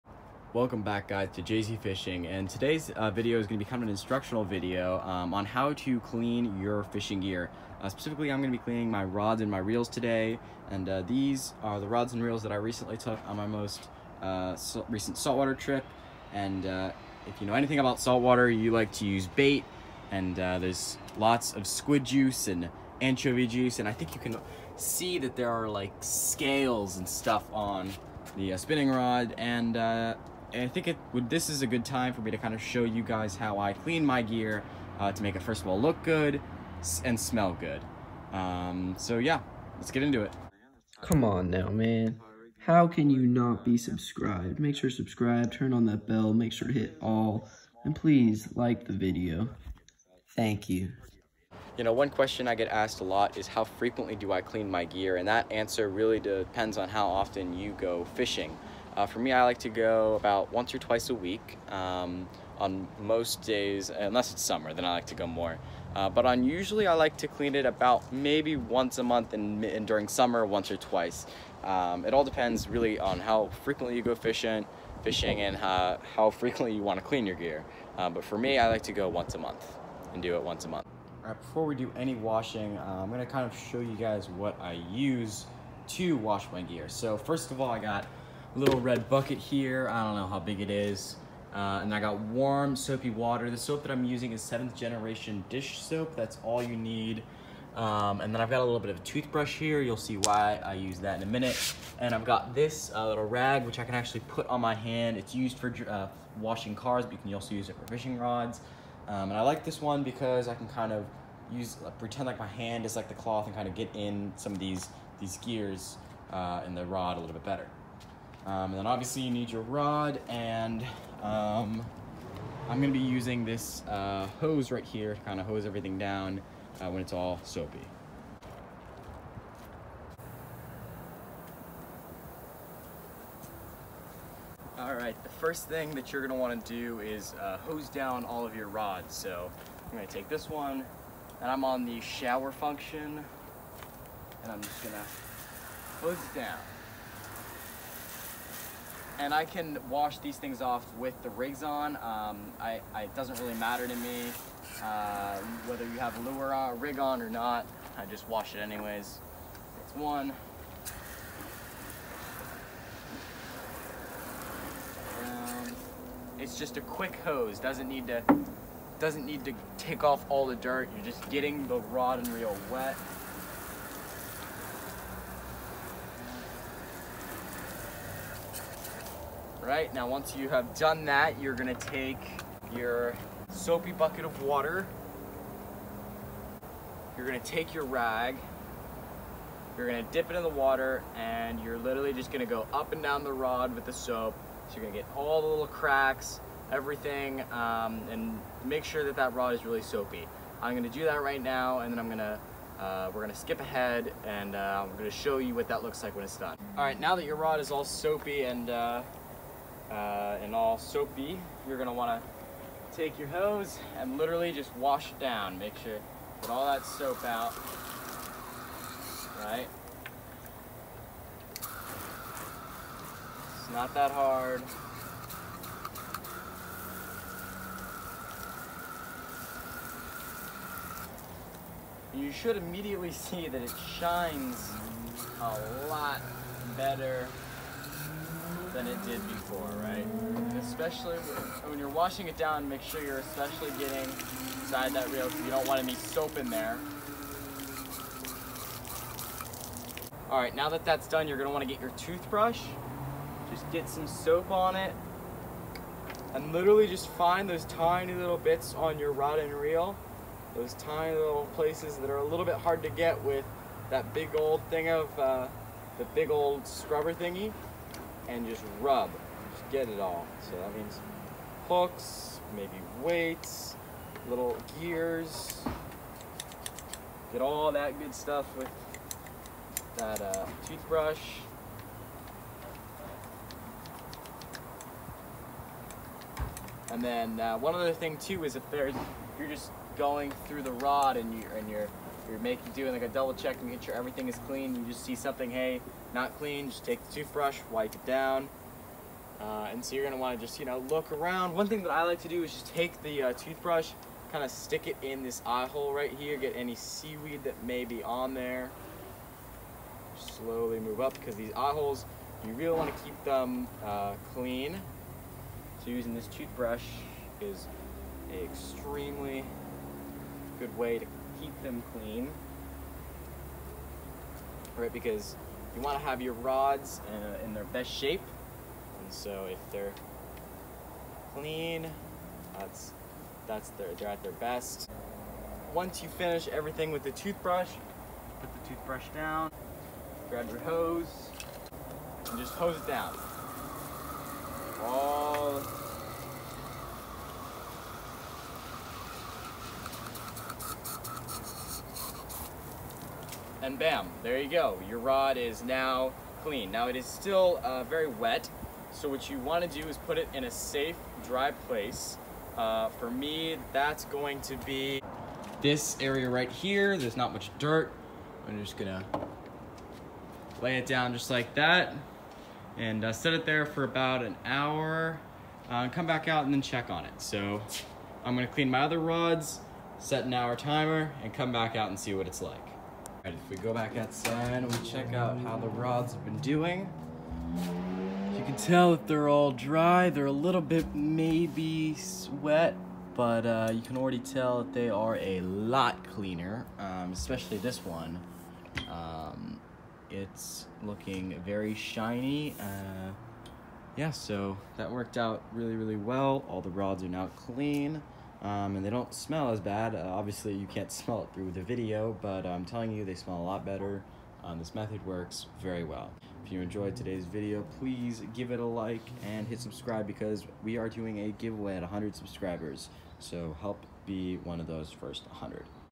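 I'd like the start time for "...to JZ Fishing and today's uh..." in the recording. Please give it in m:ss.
0:01.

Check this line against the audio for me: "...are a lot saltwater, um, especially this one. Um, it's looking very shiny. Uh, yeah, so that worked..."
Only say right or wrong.
wrong.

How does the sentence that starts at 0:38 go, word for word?
Um, so yeah, let's get into it.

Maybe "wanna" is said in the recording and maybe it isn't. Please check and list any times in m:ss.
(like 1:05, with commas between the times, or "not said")
2:16, 3:31, 4:11, 5:00, 5:12, 5:59.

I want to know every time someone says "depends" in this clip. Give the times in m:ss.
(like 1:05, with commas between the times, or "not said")
0:56, 1:12.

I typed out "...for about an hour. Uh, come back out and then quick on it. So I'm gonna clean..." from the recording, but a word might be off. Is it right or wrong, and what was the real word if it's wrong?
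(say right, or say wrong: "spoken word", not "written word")
wrong: "check", not "quick".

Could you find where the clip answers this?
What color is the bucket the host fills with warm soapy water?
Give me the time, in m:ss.
1:28.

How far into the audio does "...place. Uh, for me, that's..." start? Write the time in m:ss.
6:01.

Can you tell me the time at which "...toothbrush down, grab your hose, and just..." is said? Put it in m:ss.
5:38.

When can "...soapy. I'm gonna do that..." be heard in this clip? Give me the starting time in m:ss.
3:19.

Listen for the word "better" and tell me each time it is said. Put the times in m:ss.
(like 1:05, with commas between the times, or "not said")
1:57, 3:56, 6:53.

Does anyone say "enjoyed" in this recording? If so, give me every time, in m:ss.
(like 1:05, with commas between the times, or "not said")
6:56.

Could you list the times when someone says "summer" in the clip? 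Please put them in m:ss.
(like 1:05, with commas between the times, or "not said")
1:04, 1:10.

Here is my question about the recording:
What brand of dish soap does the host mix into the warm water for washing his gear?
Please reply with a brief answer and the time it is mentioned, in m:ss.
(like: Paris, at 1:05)
Seventh Generation, at 1:34.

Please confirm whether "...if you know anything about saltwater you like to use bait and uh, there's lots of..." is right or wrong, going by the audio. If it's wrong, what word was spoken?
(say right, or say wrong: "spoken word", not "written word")
right.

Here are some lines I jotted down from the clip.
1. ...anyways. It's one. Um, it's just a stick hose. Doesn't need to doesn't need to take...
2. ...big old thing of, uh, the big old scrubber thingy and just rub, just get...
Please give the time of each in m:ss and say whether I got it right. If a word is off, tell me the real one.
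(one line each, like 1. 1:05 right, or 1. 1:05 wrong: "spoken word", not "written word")
1. 2:38 wrong: "quick", not "stick"
2. 4:24 right.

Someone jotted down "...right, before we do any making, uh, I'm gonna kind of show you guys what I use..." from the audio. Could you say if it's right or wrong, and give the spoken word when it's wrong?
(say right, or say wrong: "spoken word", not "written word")
wrong: "washing", not "making".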